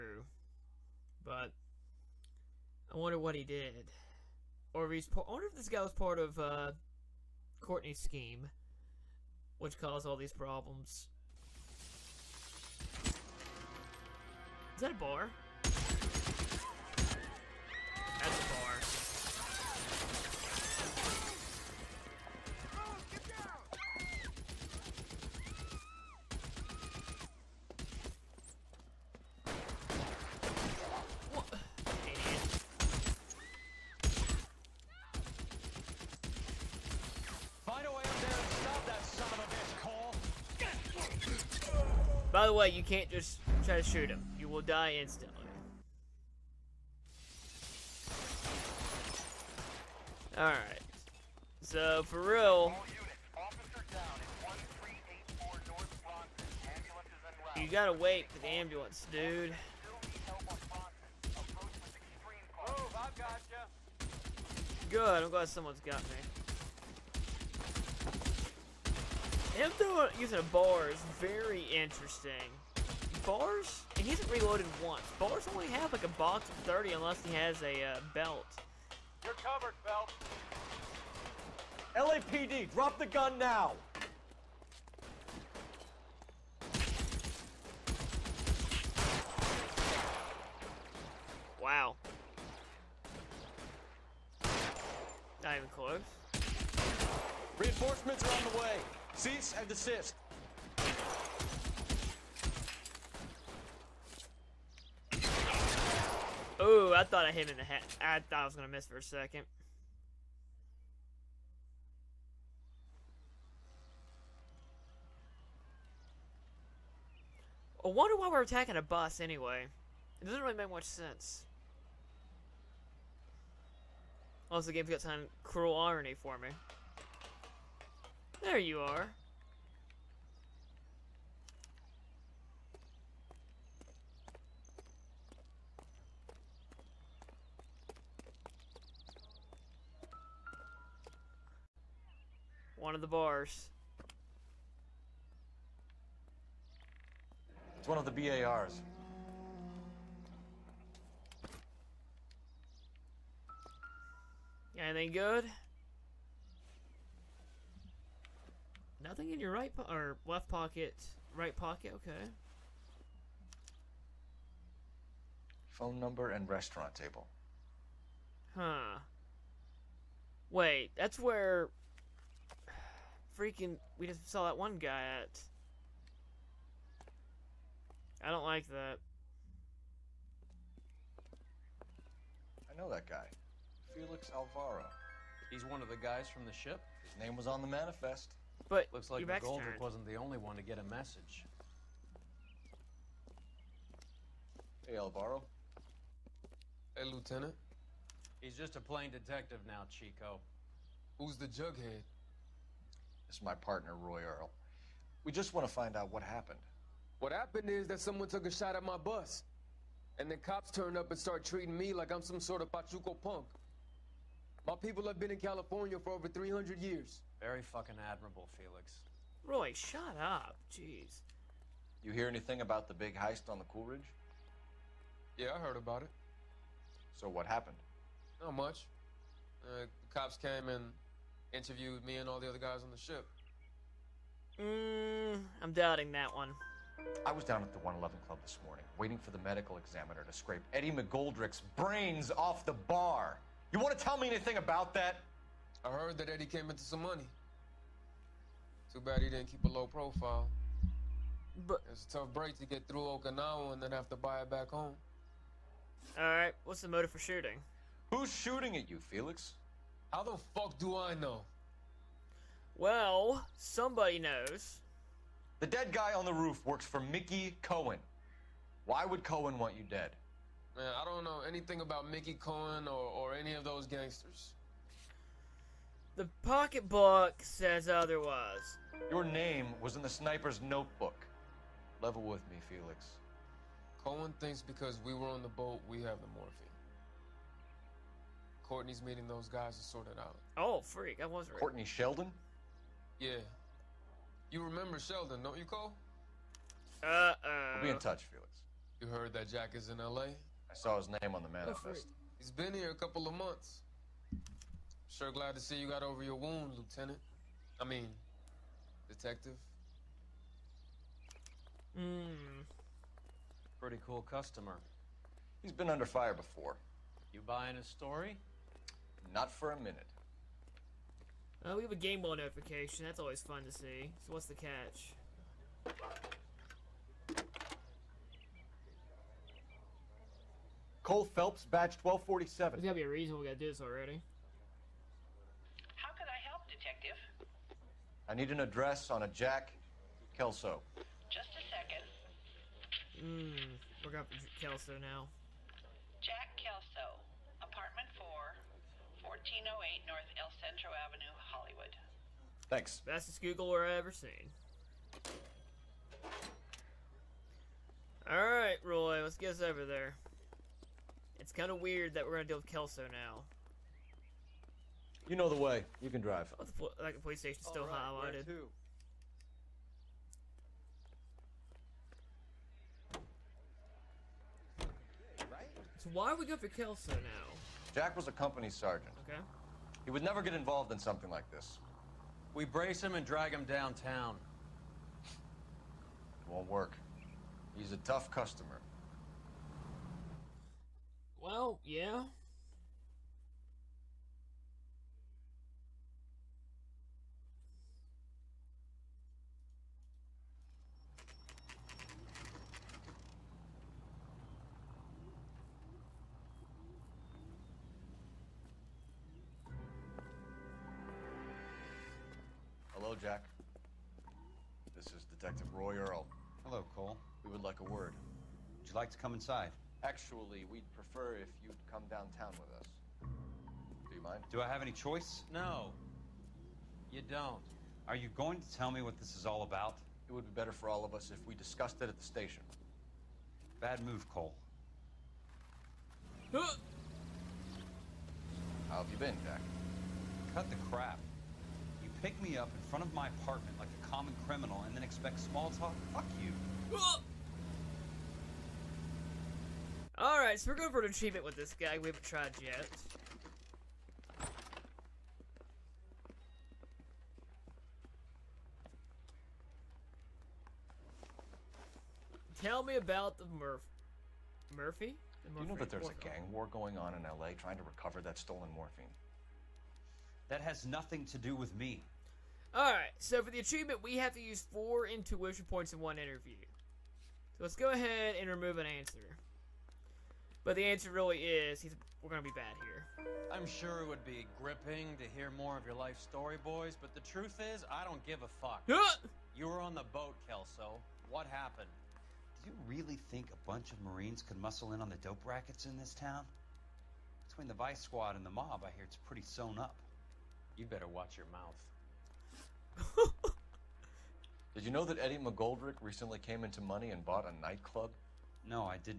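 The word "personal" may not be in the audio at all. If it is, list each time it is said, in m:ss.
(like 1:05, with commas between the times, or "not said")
not said.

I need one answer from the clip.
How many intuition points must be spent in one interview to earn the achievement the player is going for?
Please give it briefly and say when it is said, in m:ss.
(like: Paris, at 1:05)
4, at 7:54.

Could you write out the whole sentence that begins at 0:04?
Or if he's I wonder if this guy was part of uh, Courtney's scheme, which caused all these problems.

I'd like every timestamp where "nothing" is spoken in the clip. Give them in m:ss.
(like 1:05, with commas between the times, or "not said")
2:39, 7:50.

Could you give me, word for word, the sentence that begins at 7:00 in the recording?
Actually, we'd prefer if you'd come downtown with us.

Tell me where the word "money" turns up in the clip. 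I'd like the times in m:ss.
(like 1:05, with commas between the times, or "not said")
4:07, 8:26.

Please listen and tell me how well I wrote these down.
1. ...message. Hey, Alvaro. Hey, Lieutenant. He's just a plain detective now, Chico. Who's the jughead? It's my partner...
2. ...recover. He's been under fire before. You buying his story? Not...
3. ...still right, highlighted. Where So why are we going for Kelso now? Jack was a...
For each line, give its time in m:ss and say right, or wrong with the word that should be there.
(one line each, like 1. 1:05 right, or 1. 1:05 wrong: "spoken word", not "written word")
1. 3:10 right
2. 5:14 wrong: "customer", not "recover"
3. 6:07 right.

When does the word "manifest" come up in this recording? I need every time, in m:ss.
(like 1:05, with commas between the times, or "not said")
3:07, 5:01.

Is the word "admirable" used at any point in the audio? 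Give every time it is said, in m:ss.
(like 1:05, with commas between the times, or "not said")
3:38.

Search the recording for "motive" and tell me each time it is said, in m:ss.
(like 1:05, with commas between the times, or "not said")
4:16.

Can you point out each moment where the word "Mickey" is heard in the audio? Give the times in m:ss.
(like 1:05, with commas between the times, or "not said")
4:26, 4:32.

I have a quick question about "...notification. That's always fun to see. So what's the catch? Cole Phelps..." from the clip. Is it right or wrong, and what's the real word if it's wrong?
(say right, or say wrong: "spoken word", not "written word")
right.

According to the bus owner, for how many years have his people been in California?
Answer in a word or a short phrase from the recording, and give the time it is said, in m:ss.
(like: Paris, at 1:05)
300, at 3:36.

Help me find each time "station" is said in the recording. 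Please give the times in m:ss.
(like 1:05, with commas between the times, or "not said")
6:07, 7:12.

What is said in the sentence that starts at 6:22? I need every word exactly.
We brace him and drag him downtown.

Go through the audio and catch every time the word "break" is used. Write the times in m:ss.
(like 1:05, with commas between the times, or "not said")
4:12.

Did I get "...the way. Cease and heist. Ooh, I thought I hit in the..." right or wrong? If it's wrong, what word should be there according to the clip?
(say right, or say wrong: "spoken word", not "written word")
wrong: "desist", not "heist".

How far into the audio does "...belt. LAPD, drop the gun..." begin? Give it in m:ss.
1:19.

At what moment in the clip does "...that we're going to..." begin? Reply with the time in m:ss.
6:02.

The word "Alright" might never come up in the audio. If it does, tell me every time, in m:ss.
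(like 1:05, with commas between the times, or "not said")
5:58, 7:30, 7:52.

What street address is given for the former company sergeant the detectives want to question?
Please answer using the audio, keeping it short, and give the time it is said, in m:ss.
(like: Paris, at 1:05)
1408 North El Centro Avenue, at 5:49.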